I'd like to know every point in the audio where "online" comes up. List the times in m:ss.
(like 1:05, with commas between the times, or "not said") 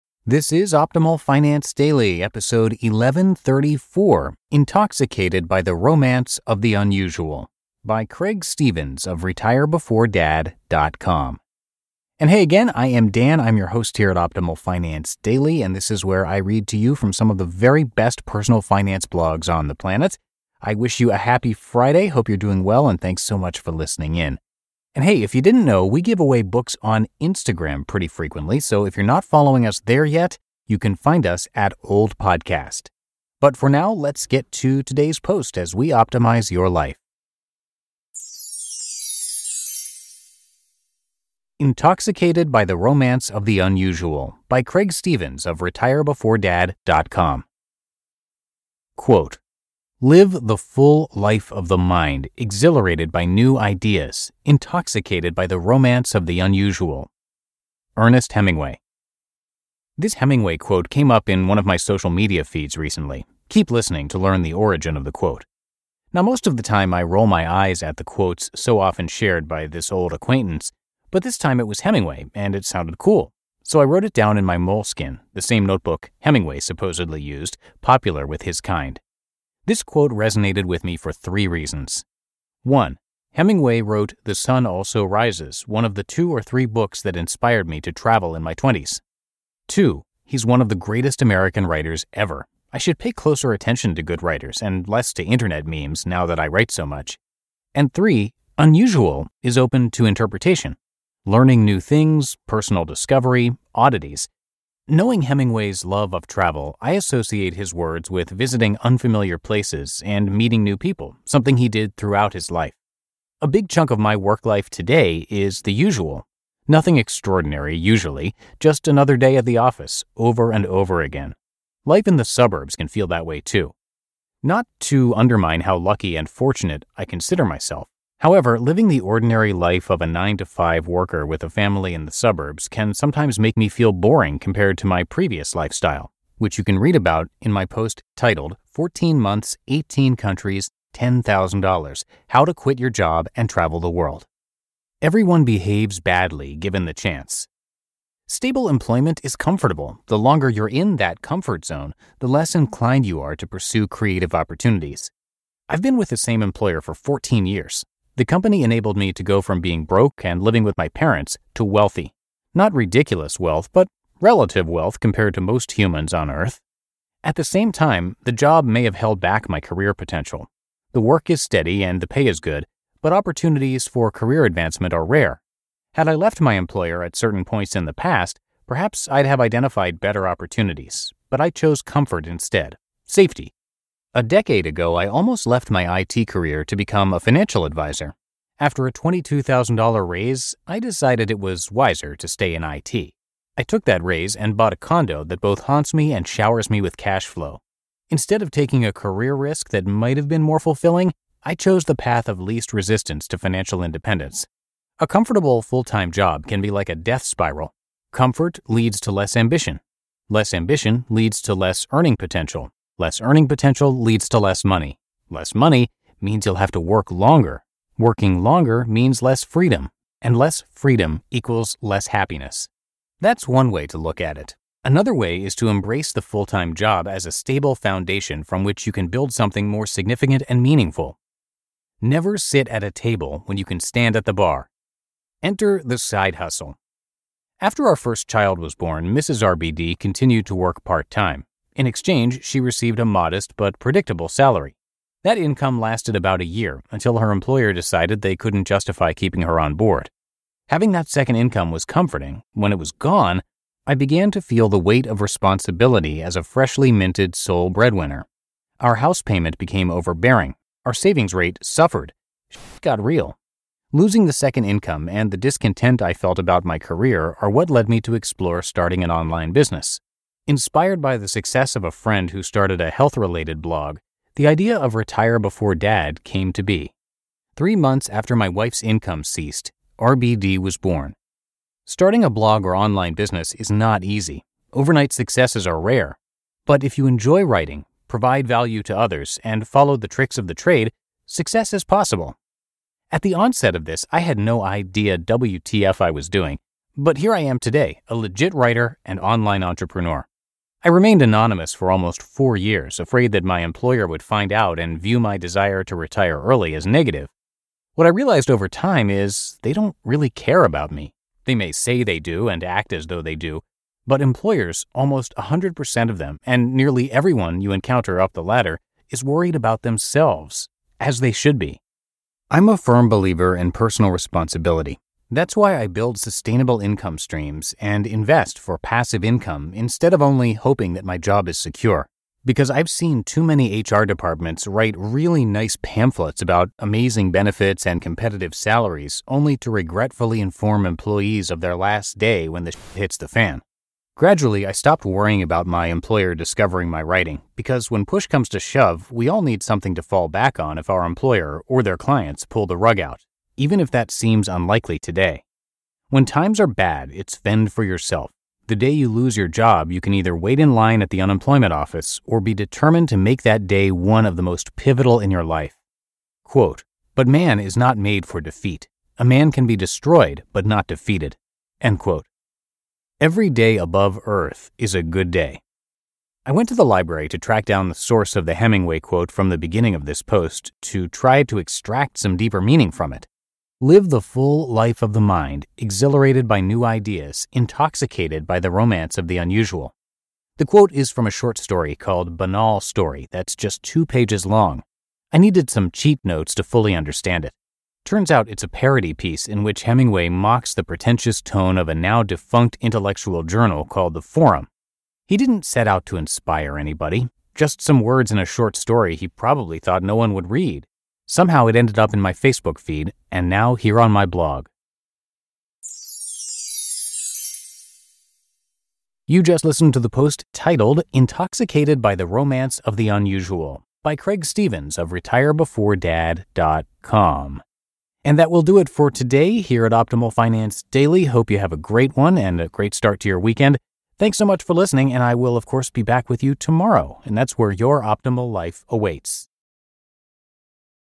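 4:29, 4:42, 4:59.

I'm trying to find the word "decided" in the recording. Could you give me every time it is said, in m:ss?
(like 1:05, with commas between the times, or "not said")
3:10, 4:07.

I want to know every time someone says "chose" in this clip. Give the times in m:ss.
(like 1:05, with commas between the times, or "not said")
3:01, 3:21.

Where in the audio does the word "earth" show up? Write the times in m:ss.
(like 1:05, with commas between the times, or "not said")
2:46, 6:14.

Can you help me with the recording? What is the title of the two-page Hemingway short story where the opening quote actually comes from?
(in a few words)
Banal Story.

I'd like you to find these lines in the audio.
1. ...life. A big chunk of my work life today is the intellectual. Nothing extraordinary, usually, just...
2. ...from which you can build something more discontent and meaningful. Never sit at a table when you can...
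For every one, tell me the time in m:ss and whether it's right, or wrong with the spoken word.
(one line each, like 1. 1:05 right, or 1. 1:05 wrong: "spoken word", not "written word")
1. 1:52 wrong: "usual", not "intellectual"
2. 3:48 wrong: "significant", not "discontent".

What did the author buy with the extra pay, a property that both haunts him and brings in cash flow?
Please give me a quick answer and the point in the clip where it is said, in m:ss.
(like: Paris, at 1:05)
A condo, at 3:14.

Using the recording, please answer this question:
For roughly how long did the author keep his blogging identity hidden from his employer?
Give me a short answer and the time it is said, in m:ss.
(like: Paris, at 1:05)
Almost 4 years, at 5:01.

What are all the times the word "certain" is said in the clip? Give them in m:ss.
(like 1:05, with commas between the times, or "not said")
2:57.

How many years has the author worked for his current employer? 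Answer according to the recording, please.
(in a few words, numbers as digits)
14.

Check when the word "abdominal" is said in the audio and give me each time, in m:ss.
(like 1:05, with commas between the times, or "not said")
not said.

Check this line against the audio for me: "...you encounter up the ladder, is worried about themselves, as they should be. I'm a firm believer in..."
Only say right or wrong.
right.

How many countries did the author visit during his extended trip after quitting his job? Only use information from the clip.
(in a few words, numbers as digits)
18.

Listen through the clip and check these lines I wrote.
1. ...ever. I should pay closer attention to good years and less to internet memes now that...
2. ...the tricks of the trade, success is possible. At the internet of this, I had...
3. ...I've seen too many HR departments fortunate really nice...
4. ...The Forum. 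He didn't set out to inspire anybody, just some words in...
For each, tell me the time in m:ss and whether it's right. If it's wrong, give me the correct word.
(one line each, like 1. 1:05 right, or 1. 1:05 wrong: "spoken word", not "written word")
1. 1:32 wrong: "writers", not "years"
2. 4:49 wrong: "onset", not "internet"
3. 5:32 wrong: "write", not "fortunate"
4. 6:44 right.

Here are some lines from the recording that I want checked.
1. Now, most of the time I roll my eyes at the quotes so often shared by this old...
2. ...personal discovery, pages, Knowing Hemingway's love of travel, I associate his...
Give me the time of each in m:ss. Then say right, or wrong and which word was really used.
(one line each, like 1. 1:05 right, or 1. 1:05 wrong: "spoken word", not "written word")
1. 1:06 right
2. 1:42 wrong: "oddities", not "pages".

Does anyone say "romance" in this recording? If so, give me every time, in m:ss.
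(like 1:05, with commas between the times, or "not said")
0:05, 0:42, 0:55, 6:28, 7:02.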